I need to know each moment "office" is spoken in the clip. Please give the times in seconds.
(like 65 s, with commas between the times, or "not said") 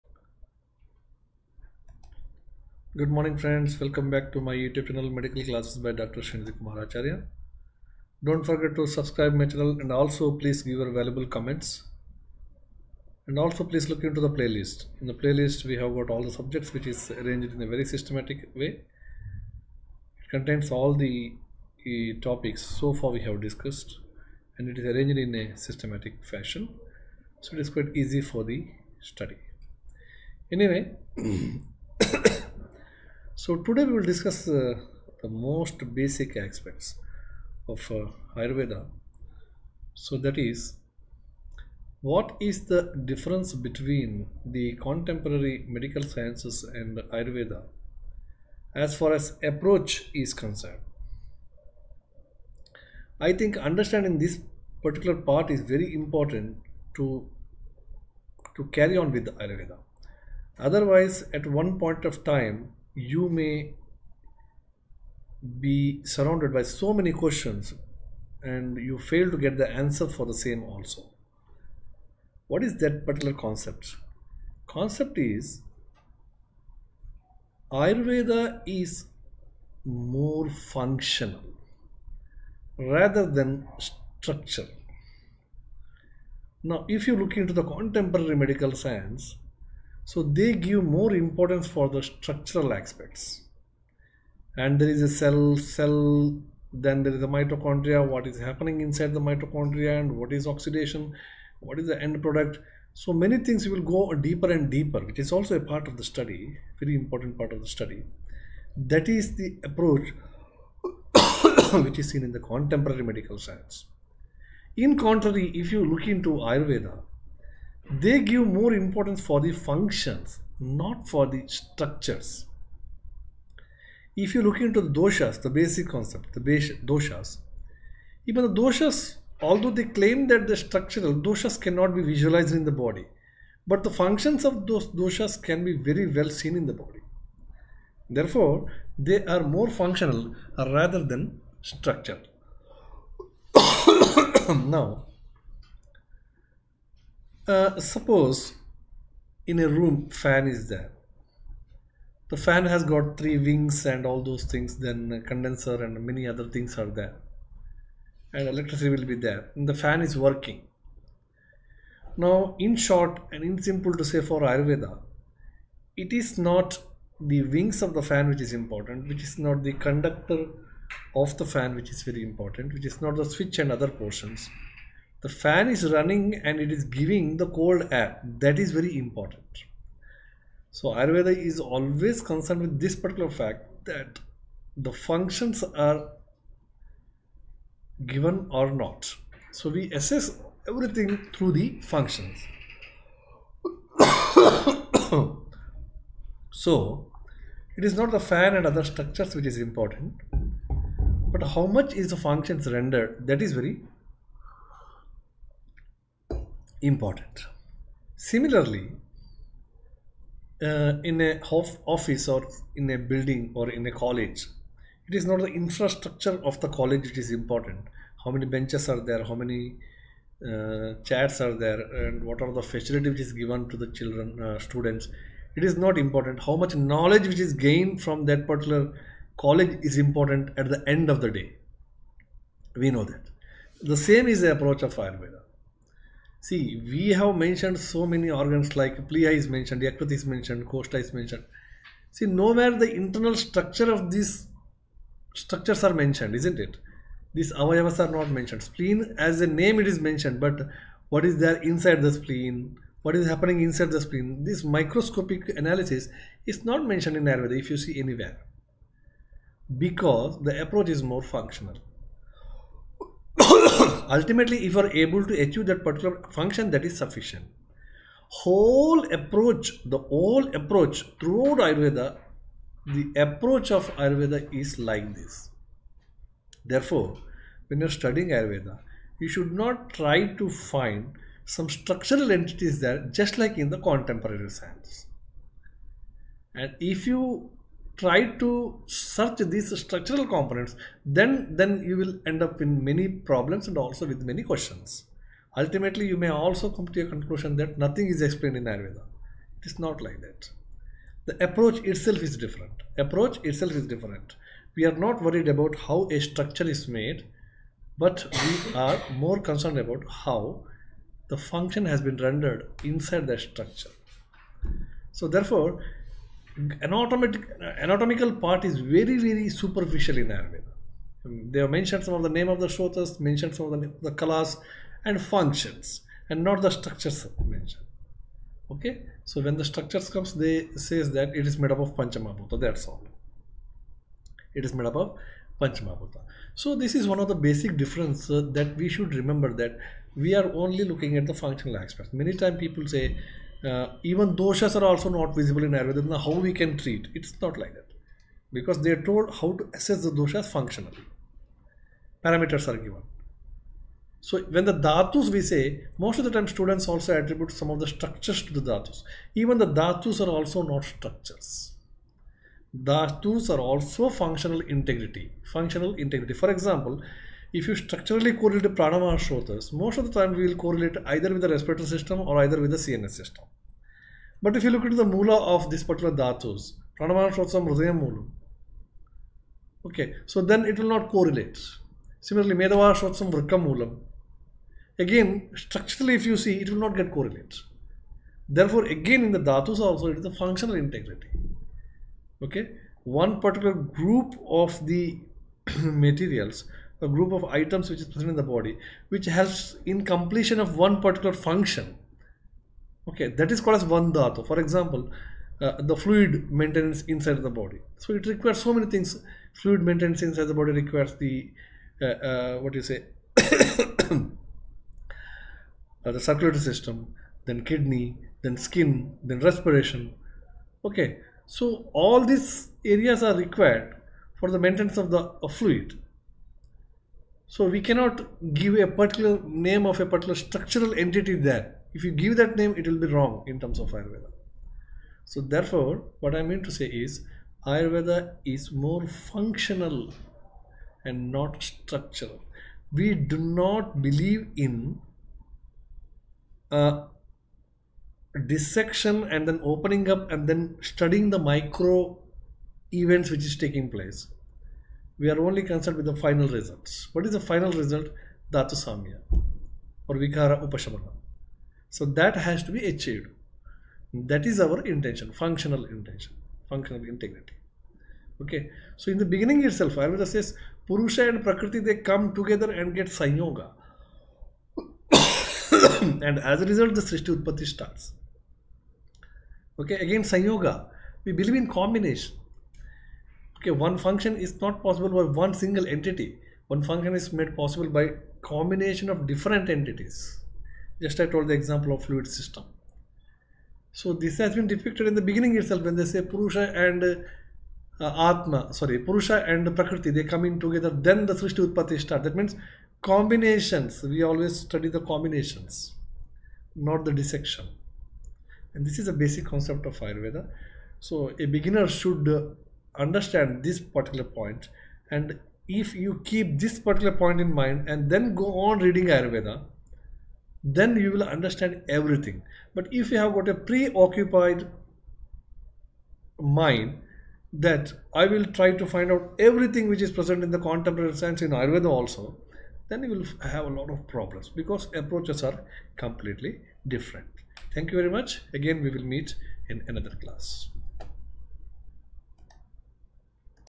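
211 s.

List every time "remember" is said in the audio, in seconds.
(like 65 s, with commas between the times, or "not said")
339 s.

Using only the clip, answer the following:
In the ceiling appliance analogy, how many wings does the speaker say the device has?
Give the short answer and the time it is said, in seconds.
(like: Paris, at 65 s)
3, at 153 s.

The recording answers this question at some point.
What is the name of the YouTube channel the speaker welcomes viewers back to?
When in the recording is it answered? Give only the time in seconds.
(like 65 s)
5 s.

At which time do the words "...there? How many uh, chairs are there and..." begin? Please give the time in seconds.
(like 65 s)
219 s.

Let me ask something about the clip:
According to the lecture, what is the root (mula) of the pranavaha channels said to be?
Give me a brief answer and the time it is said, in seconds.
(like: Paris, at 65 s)
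Hridayam, at 377 s.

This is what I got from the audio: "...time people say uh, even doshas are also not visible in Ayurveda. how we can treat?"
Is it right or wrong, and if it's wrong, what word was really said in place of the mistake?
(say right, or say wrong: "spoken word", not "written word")
right.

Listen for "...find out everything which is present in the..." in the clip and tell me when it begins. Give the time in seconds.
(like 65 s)
528 s.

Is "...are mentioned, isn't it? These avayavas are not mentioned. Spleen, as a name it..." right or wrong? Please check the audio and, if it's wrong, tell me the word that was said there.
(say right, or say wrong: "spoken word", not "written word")
right.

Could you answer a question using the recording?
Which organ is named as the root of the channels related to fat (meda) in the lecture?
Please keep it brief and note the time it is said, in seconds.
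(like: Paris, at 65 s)
Vrikkam, at 383 s.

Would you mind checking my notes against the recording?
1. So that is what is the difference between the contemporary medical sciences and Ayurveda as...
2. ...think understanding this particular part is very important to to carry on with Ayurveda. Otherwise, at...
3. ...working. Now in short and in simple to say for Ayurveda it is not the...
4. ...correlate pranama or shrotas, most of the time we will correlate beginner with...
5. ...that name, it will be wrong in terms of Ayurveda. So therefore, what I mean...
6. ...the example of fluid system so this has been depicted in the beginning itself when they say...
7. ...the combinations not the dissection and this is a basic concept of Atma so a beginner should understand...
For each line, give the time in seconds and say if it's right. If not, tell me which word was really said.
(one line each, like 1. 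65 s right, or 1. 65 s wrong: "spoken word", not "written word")
1. 39 s right
2. 53 s right
3. 160 s right
4. 368 s wrong: "either", not "beginner"
5. 432 s right
6. 491 s right
7. 504 s wrong: "Ayurveda", not "Atma".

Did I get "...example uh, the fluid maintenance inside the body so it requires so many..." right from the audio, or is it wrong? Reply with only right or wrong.
right.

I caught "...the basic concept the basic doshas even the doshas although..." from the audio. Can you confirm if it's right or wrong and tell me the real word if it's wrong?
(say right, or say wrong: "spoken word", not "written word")
right.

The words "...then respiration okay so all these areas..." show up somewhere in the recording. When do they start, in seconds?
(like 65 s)
419 s.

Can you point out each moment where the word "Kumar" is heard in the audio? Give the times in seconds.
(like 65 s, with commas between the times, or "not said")
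6 s.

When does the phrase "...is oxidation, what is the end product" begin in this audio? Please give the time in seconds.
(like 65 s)
100 s.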